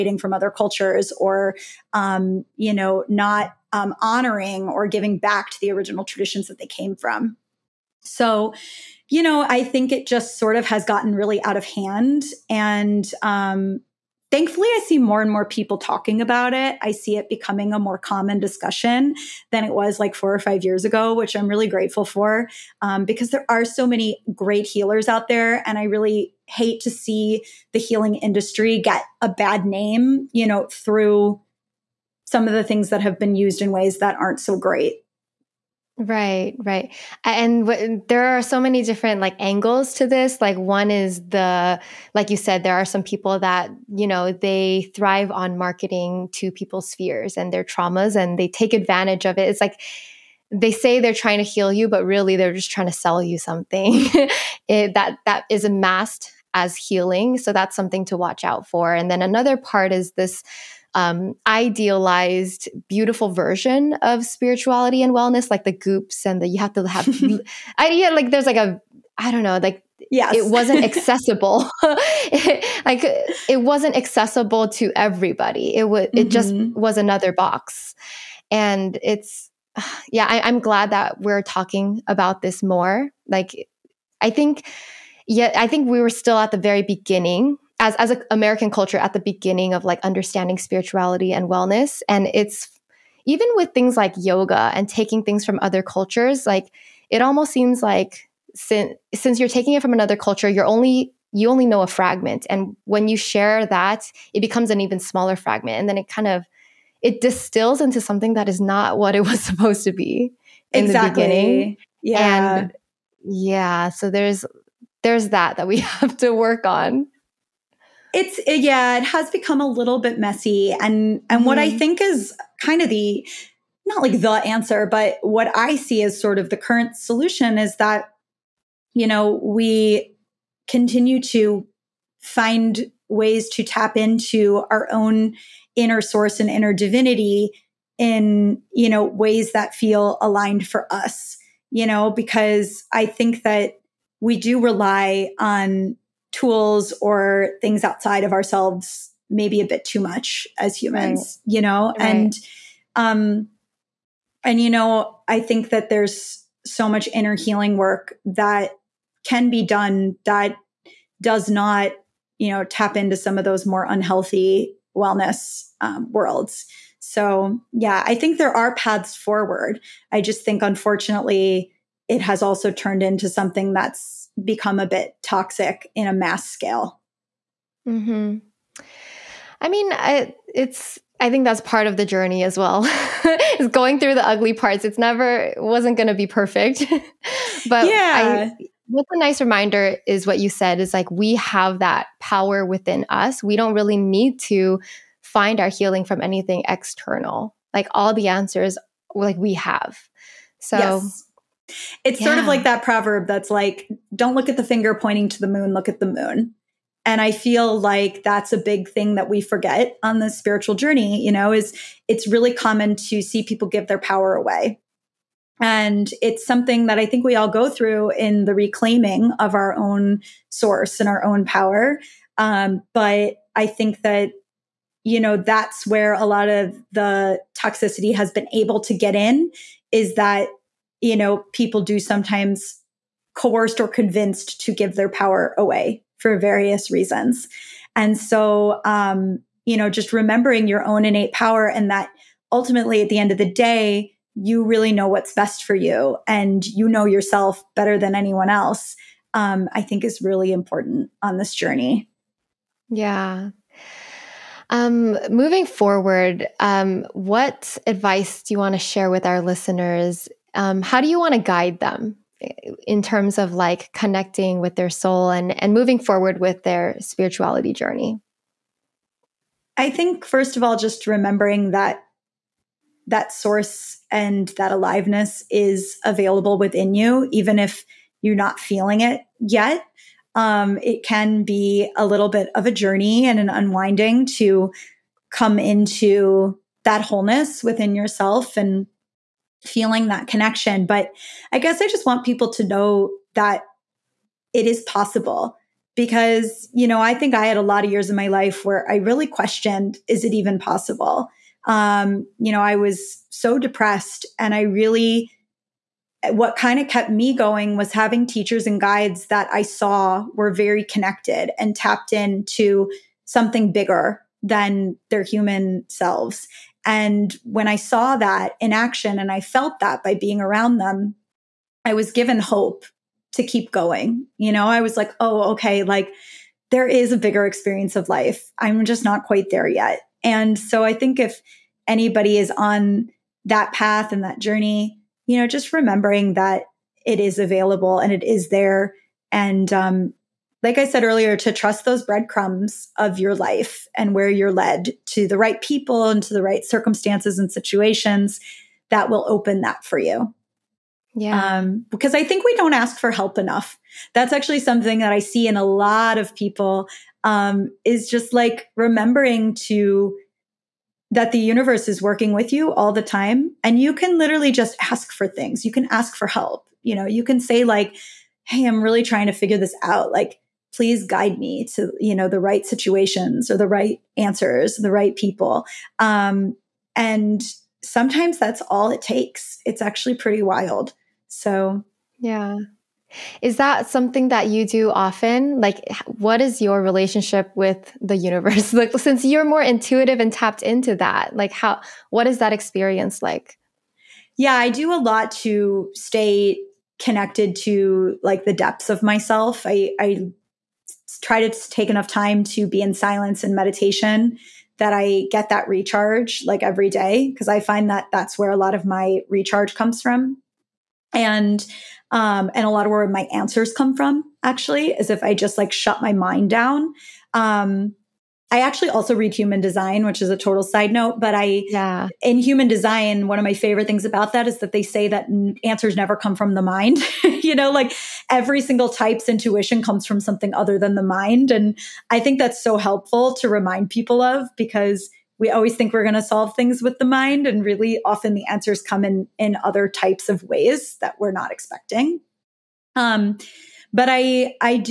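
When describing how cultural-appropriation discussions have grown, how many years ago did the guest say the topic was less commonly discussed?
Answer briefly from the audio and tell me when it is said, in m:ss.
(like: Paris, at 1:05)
4 or 5 years, at 0:20.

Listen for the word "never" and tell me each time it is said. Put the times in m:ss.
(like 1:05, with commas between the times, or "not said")
3:04, 7:05.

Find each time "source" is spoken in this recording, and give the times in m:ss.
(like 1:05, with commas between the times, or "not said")
2:15, 3:40, 4:33.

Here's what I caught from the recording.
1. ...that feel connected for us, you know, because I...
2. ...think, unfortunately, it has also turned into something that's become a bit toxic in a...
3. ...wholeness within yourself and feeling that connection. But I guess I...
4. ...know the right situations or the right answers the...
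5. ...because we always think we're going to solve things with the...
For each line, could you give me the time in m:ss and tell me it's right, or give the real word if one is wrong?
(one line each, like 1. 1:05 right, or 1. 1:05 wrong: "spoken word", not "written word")
1. 2:19 wrong: "aligned", not "connected"
2. 2:50 right
3. 4:47 right
4. 6:12 right
5. 7:14 right.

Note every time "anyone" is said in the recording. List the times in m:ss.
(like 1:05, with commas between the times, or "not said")
4:08.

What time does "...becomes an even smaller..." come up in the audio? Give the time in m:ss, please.
1:44.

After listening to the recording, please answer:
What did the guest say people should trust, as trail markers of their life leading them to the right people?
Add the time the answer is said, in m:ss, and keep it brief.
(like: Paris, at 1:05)
Breadcrumbs, at 5:42.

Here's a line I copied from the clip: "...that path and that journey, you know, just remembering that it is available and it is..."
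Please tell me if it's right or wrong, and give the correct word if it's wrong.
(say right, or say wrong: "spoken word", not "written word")
right.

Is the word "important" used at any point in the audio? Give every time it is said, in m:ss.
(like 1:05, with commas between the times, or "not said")
4:10.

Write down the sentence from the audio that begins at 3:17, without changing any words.
Like all the answers like we have.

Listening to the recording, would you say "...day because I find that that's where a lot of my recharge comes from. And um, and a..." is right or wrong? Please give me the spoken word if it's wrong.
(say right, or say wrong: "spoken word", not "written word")
right.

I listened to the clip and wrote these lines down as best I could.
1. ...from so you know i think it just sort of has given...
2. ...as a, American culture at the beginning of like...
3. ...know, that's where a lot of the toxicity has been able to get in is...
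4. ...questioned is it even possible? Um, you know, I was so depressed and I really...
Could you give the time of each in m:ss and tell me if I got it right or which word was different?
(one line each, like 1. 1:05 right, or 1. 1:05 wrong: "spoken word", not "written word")
1. 0:06 wrong: "gotten", not "given"
2. 1:27 right
3. 3:45 right
4. 4:59 right.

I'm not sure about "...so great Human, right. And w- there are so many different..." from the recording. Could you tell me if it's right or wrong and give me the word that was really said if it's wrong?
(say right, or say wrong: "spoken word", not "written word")
wrong: "Right", not "Human".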